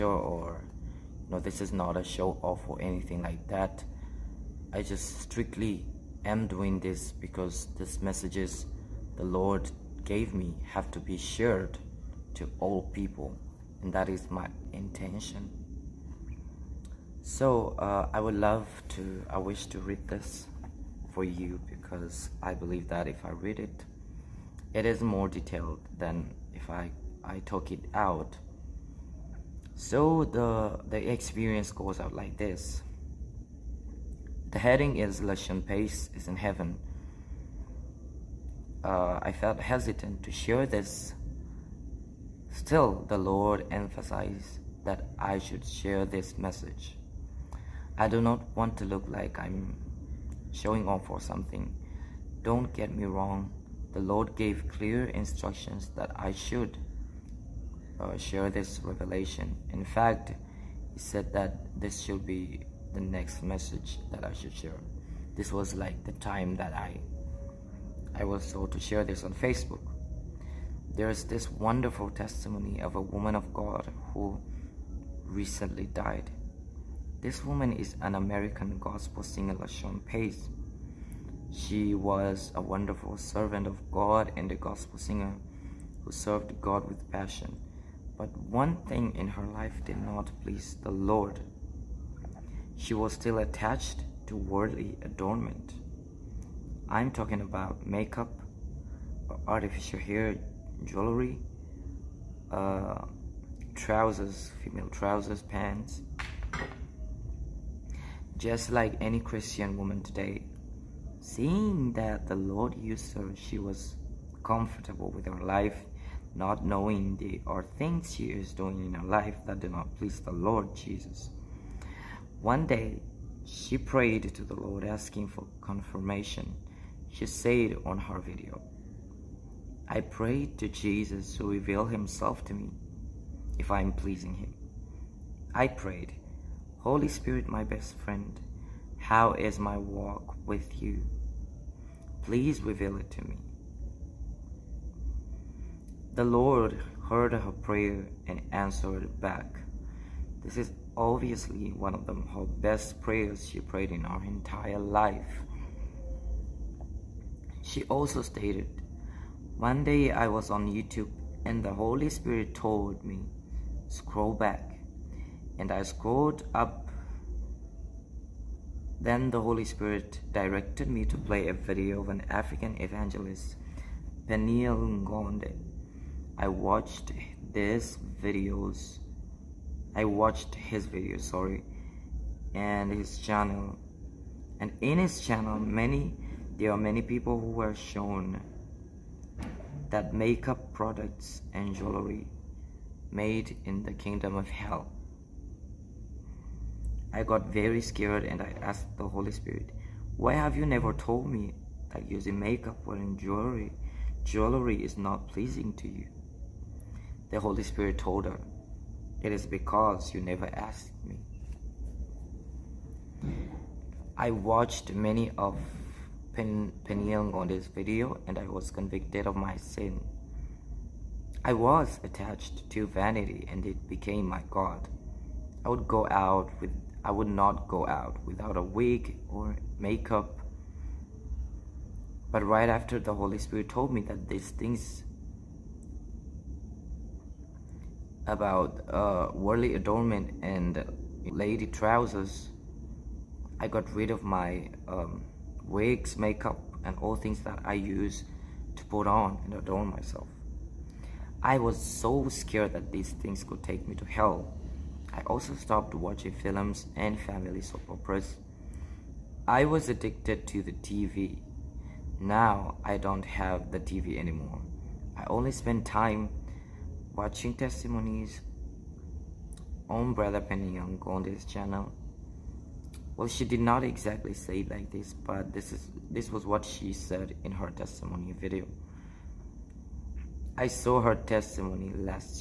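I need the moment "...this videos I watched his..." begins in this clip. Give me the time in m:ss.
2:57.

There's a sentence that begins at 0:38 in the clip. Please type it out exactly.
Uh, I felt hesitant to share this.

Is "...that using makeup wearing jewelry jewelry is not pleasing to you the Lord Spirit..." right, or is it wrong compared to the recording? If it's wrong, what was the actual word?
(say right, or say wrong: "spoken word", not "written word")
wrong: "Holy", not "Lord".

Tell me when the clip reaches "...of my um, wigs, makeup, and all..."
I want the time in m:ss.
4:04.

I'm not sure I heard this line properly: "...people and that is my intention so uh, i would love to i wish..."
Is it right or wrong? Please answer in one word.
right.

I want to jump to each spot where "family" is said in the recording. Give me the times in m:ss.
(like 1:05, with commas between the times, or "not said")
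4:17.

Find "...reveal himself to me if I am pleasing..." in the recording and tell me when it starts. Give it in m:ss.
2:11.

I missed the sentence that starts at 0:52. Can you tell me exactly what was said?
Don't get me wrong, the Lord gave clear instructions that I should uh, share this revelation.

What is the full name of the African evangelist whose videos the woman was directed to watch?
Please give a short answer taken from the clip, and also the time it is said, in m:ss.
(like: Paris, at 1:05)
Peniel Ngonde, at 2:54.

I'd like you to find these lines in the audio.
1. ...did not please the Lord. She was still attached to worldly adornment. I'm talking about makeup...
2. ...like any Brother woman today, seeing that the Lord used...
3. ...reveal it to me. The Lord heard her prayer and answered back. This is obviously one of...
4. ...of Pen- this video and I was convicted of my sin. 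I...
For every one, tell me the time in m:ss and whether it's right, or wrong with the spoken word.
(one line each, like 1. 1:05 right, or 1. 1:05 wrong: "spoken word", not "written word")
1. 1:29 right
2. 1:48 wrong: "Christian", not "Brother"
3. 2:22 right
4. 3:35 right.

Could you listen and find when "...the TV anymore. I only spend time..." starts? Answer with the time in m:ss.
4:23.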